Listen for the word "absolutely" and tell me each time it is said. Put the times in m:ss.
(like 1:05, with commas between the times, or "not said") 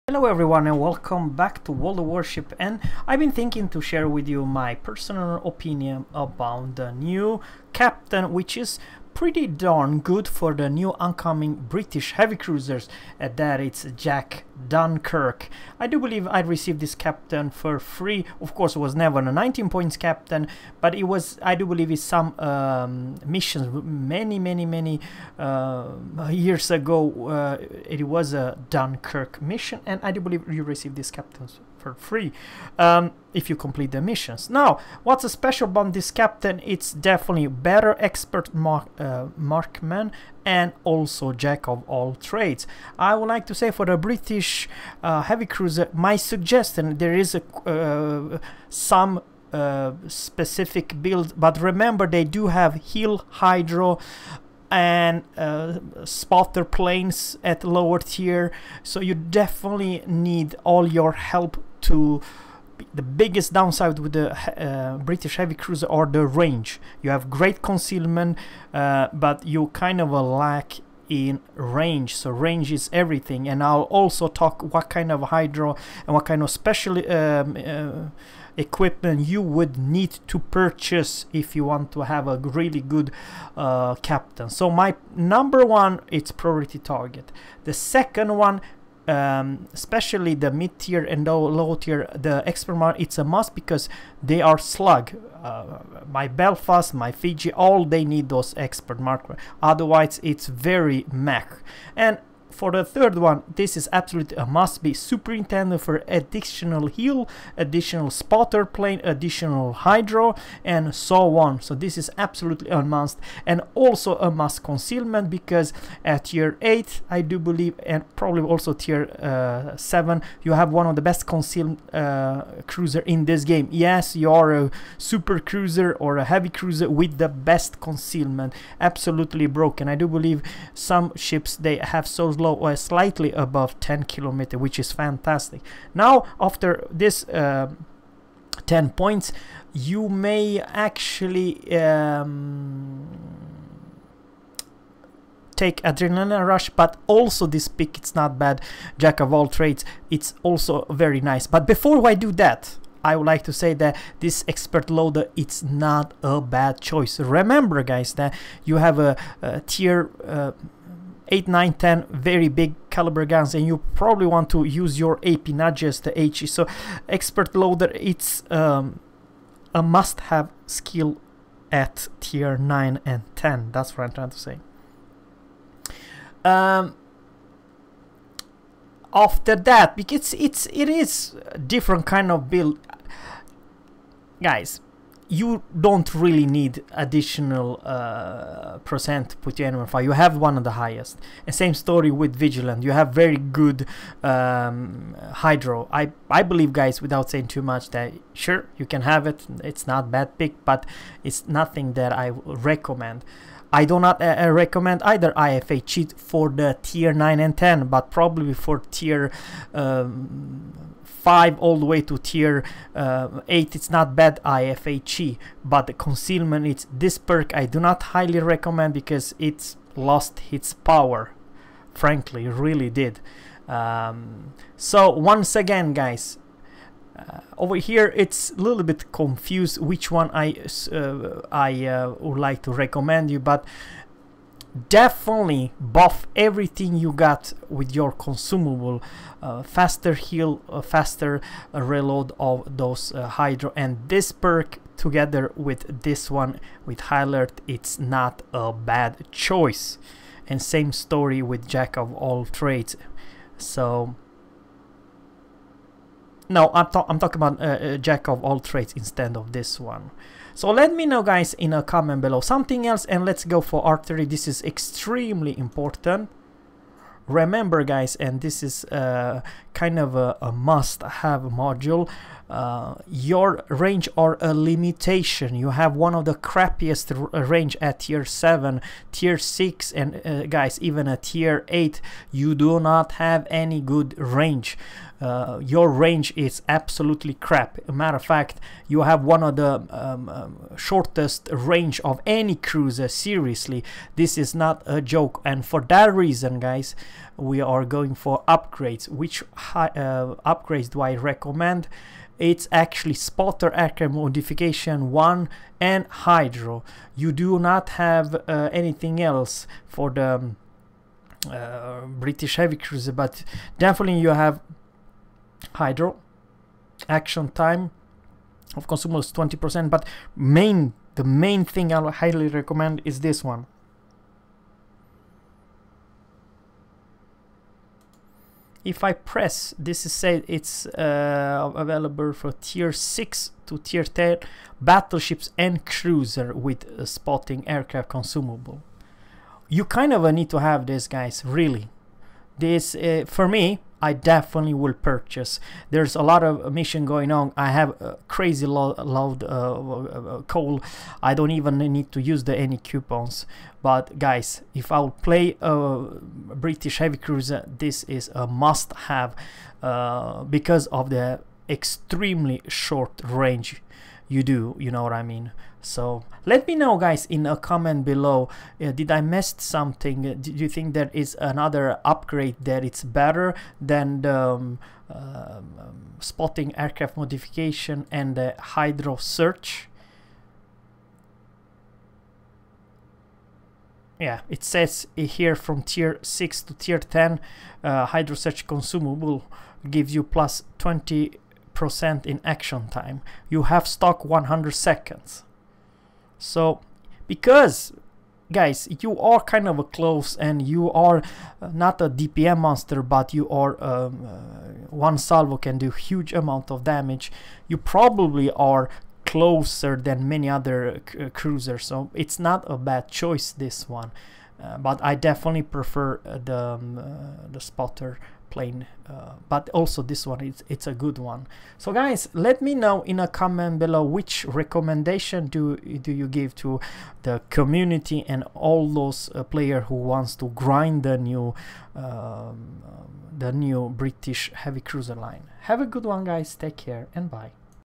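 1:43, 1:52, 2:08, 4:46.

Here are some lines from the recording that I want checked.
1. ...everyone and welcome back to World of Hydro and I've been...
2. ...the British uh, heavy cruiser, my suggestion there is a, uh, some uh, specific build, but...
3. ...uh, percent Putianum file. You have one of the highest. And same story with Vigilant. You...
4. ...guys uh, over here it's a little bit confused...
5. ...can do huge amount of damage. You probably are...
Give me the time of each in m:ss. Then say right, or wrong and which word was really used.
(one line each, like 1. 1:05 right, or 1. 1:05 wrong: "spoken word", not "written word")
1. 0:00 wrong: "Warship", not "Hydro"
2. 0:43 right
3. 3:07 right
4. 3:45 right
5. 6:45 right.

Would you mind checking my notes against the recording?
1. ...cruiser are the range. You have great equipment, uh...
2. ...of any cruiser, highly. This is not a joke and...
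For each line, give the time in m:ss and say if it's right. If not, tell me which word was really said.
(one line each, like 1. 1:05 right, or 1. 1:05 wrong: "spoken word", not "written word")
1. 1:05 wrong: "concealment", not "equipment"
2. 4:52 wrong: "seriously", not "highly".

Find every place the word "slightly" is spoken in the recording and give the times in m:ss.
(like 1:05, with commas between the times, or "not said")
2:12.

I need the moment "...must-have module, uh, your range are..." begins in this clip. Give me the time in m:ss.
4:30.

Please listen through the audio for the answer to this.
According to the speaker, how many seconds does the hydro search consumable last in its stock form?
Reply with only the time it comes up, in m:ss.
6:34.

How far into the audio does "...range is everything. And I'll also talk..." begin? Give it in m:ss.
1:12.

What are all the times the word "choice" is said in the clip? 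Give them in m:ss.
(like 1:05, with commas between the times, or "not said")
2:36, 4:09, 6:53.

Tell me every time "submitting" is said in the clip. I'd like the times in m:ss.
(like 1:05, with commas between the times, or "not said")
not said.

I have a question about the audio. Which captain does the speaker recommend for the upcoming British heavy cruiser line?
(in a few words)
Jack Dunkirk.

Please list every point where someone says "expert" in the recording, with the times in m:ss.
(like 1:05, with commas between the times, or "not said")
0:37, 1:32, 1:38, 2:34, 2:47.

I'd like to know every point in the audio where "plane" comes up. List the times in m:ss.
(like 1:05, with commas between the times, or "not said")
0:56, 1:48, 6:58.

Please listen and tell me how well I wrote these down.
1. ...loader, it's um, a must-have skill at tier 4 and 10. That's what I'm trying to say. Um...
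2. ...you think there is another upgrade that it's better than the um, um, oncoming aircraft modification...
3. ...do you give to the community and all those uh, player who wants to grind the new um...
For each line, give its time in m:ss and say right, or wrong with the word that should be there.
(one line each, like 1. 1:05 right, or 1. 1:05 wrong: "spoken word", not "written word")
1. 2:47 wrong: "9", not "4"
2. 6:10 wrong: "spotting", not "oncoming"
3. 7:05 right.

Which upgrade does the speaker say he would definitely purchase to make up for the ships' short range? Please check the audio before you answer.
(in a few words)
spotter aircraft modification 1.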